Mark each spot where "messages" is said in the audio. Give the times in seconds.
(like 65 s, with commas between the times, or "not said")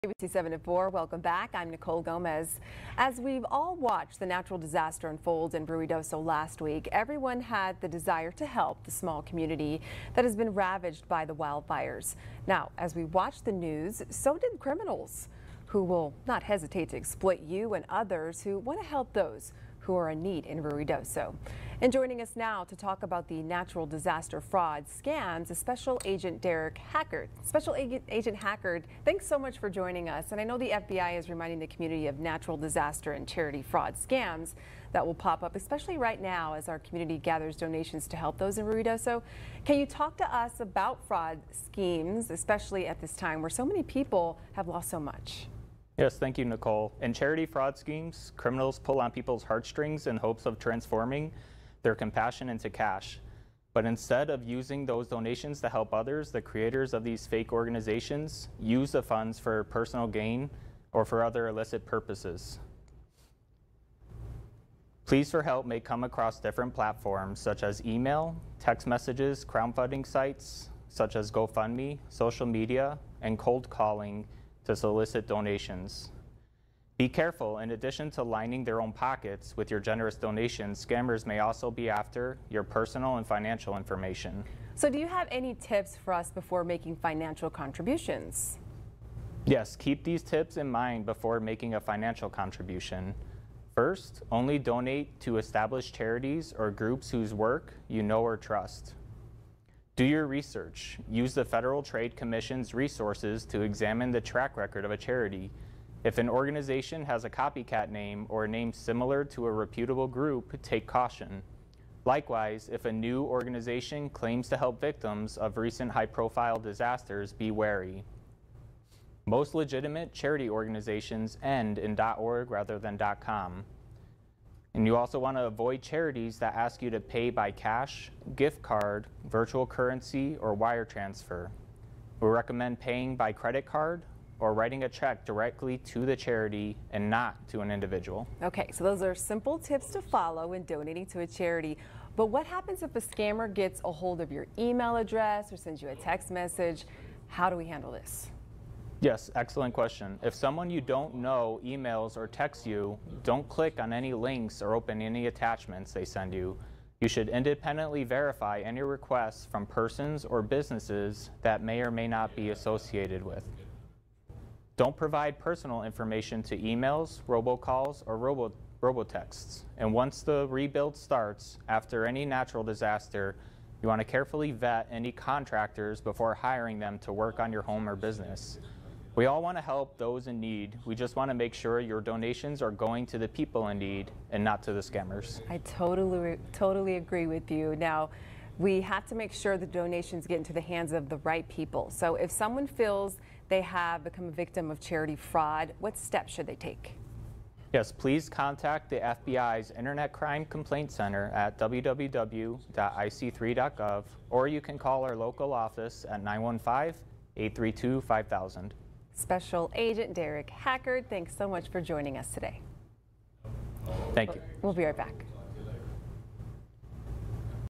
68 s, 146 s.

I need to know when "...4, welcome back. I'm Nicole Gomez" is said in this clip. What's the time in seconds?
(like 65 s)
0 s.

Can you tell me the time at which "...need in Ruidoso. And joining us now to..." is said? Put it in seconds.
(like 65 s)
20 s.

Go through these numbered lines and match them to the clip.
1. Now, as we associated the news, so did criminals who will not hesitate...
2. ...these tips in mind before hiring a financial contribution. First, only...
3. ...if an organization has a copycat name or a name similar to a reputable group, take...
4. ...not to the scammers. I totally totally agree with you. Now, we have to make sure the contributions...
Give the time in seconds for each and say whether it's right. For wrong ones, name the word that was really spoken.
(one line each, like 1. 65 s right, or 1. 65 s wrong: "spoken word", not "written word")
1. 12 s wrong: "watched", not "associated"
2. 90 s wrong: "making", not "hiring"
3. 106 s right
4. 184 s wrong: "donations", not "contributions".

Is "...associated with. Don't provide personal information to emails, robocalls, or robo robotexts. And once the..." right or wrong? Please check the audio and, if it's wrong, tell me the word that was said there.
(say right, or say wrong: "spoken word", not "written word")
right.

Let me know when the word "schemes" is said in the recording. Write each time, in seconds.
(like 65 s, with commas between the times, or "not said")
41 s, 47 s.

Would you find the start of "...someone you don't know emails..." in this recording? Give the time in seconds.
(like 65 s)
150 s.